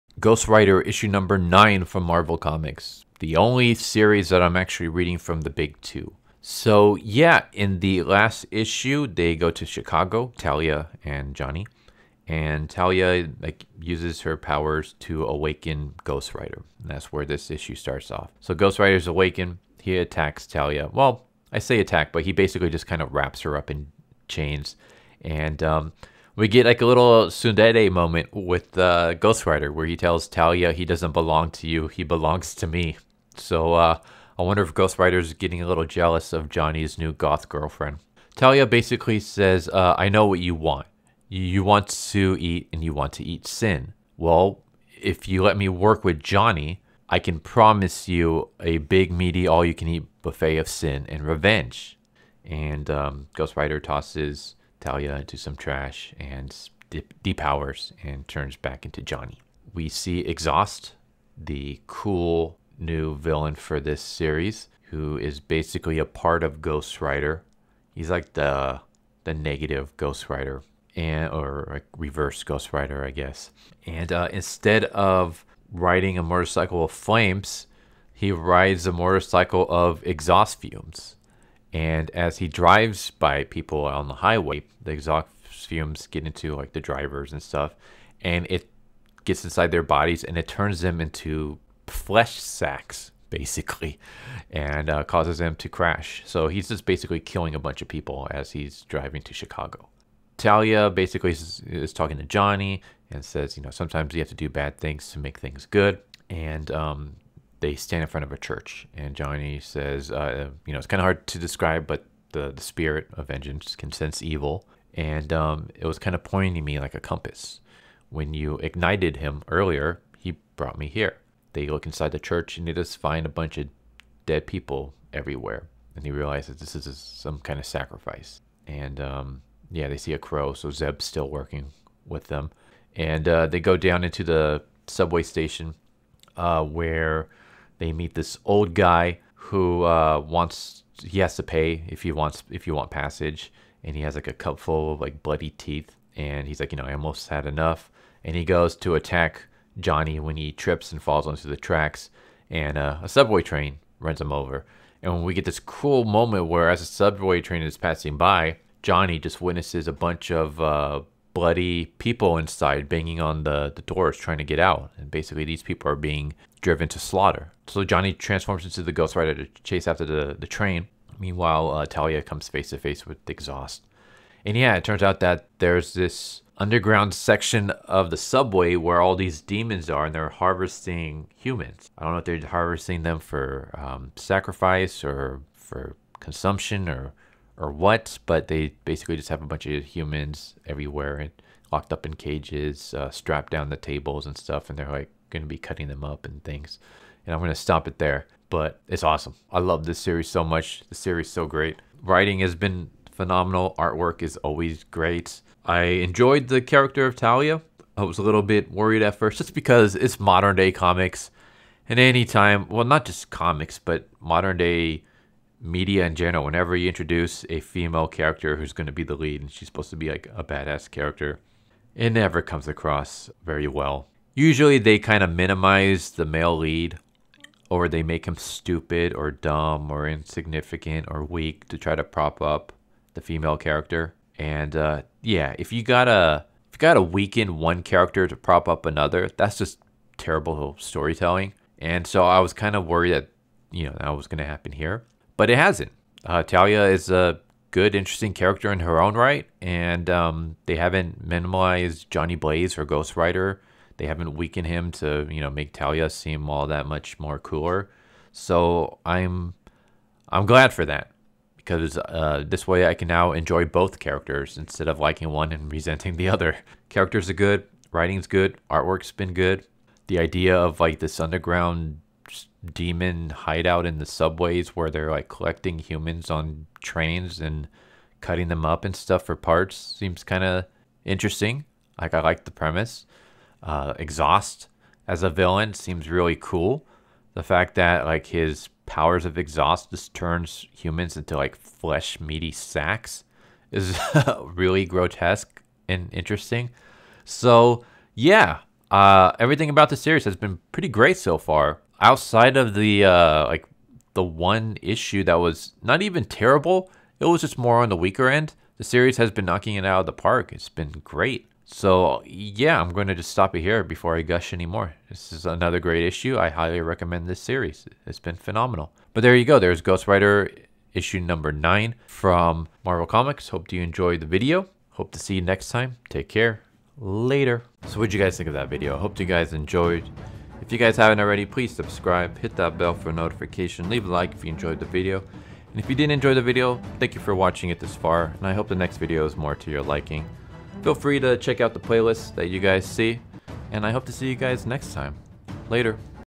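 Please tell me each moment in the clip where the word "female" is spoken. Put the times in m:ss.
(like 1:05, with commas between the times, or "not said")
3:37, 3:53.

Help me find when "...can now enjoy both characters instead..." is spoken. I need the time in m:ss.
4:22.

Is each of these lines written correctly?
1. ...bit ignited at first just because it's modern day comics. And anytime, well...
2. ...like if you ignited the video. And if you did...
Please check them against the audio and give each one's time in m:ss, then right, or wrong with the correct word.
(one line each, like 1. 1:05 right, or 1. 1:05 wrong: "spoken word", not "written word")
1. 3:28 wrong: "worried", not "ignited"
2. 5:34 wrong: "enjoyed", not "ignited".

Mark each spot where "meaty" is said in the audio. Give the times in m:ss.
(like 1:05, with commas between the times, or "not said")
0:49, 4:52.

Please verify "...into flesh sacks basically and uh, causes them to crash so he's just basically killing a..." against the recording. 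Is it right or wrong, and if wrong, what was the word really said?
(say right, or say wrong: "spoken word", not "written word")
right.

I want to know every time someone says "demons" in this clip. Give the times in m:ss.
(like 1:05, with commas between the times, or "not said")
2:59, 4:32.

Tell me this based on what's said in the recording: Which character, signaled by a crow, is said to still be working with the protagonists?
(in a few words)
Zeb.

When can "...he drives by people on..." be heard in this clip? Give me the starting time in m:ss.
1:22.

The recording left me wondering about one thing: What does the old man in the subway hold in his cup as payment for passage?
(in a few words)
Bloody teeth.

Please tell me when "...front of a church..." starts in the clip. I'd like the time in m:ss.
1:48.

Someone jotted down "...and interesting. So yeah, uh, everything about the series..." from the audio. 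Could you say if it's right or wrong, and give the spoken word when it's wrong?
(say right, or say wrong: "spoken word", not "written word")
right.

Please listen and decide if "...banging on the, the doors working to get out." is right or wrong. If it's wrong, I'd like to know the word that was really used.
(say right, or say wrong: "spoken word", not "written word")
wrong: "trying", not "working".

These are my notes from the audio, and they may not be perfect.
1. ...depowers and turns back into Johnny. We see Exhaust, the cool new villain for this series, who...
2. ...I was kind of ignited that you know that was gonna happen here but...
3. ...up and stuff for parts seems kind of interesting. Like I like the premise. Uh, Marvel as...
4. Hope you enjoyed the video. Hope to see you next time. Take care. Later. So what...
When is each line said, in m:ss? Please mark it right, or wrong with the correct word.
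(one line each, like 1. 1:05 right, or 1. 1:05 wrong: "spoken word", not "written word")
1. 0:57 right
2. 4:02 wrong: "worried", not "ignited"
3. 4:38 wrong: "Exhaust", not "Marvel"
4. 5:23 right.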